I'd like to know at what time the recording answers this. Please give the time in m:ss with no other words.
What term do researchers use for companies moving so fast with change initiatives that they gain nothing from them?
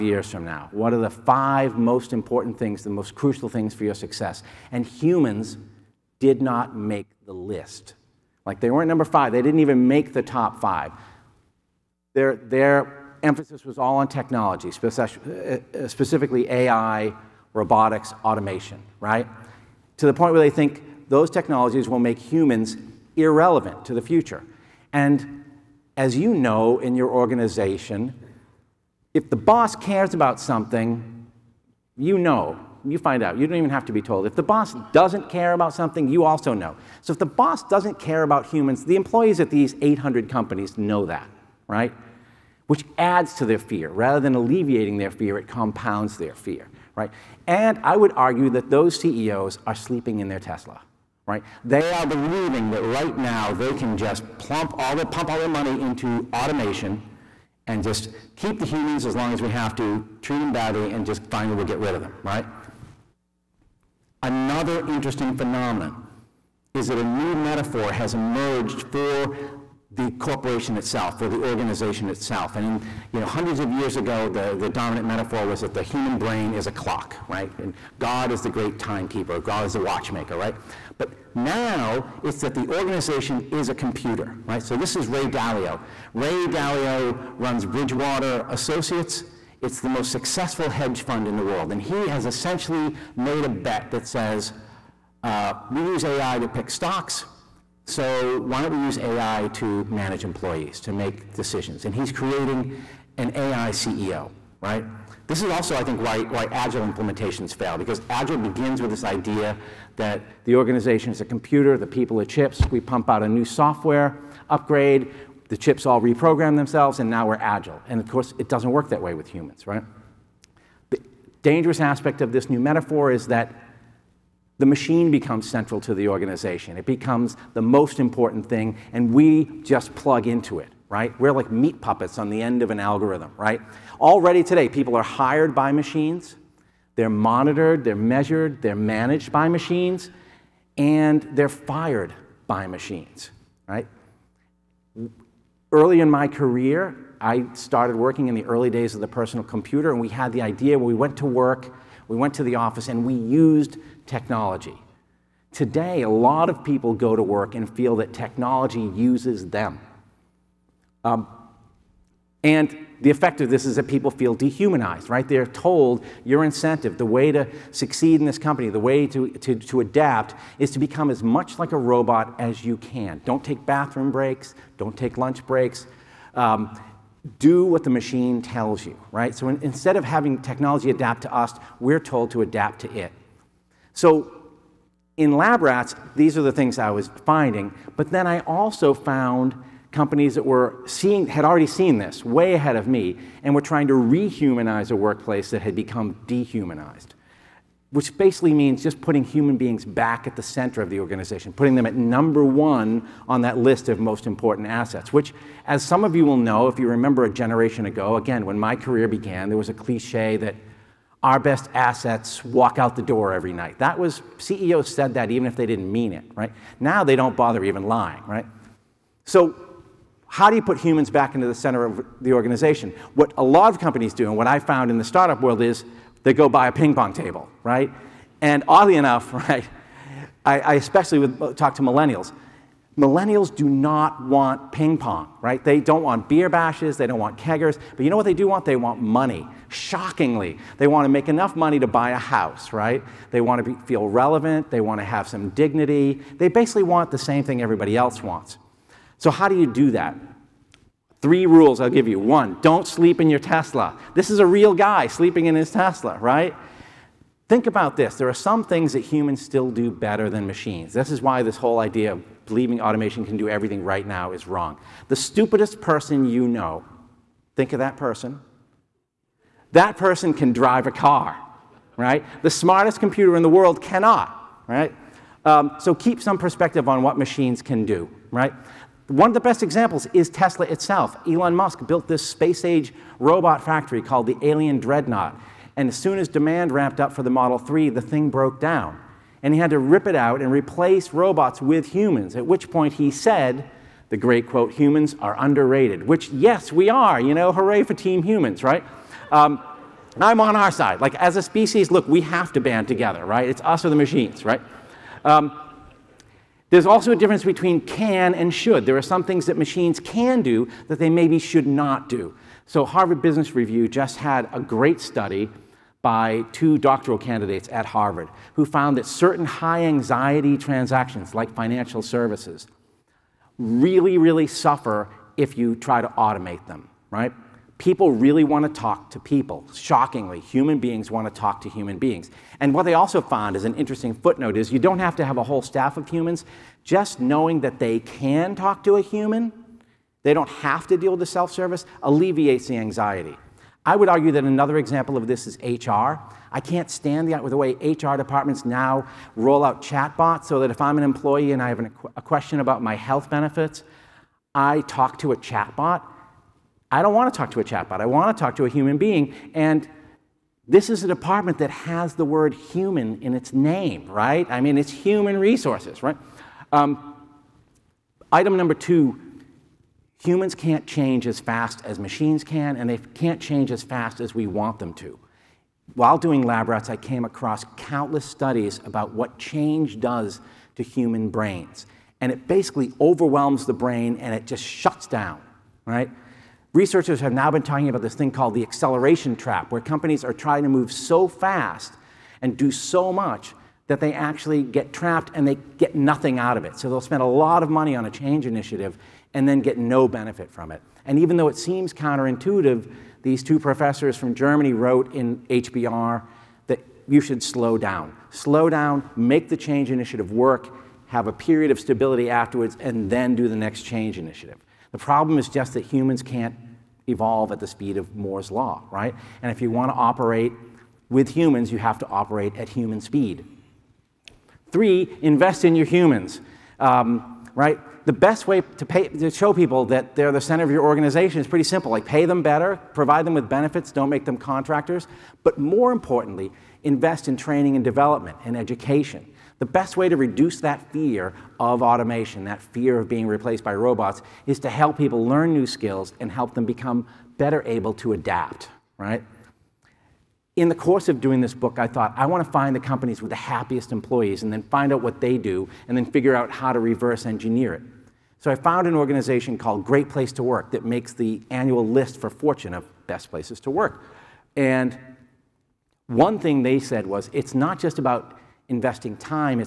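6:28.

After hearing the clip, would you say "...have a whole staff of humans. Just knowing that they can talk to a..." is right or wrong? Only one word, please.
right.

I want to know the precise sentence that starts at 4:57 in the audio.
You know, hooray for Team Humans, right?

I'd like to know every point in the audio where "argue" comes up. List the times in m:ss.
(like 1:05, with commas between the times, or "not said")
0:48, 5:44.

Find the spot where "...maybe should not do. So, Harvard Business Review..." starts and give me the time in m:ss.
5:11.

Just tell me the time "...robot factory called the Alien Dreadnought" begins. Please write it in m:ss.
4:43.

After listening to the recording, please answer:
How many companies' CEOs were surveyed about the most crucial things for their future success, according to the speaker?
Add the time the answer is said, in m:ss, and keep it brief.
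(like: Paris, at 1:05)
800, at 0:39.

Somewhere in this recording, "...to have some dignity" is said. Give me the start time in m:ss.
4:04.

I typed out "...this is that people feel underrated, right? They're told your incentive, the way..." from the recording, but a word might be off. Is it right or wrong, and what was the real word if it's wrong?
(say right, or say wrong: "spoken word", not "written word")
wrong: "dehumanized", not "underrated".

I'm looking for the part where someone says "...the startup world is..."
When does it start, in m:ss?
3:44.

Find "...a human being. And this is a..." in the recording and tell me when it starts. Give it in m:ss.
5:58.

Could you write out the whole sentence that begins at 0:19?
To the point where they think those technologies will make humans irrelevant to the future.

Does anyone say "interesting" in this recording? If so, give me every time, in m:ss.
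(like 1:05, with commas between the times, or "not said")
1:04, 5:33.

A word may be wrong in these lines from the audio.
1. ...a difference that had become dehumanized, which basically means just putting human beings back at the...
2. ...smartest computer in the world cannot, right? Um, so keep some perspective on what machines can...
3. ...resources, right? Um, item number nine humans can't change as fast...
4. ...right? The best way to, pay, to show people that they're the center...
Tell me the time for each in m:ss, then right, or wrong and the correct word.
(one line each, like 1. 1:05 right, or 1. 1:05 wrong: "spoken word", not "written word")
1. 3:14 wrong: "workplace", not "difference"
2. 4:32 right
3. 6:05 wrong: "two", not "nine"
4. 7:07 right.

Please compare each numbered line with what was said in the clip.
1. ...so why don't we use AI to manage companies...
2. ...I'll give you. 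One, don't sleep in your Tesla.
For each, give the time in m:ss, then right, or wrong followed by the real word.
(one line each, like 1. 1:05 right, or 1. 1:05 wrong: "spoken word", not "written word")
1. 1:37 wrong: "employees", not "companies"
2. 4:11 right.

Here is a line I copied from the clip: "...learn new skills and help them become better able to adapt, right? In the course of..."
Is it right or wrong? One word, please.
right.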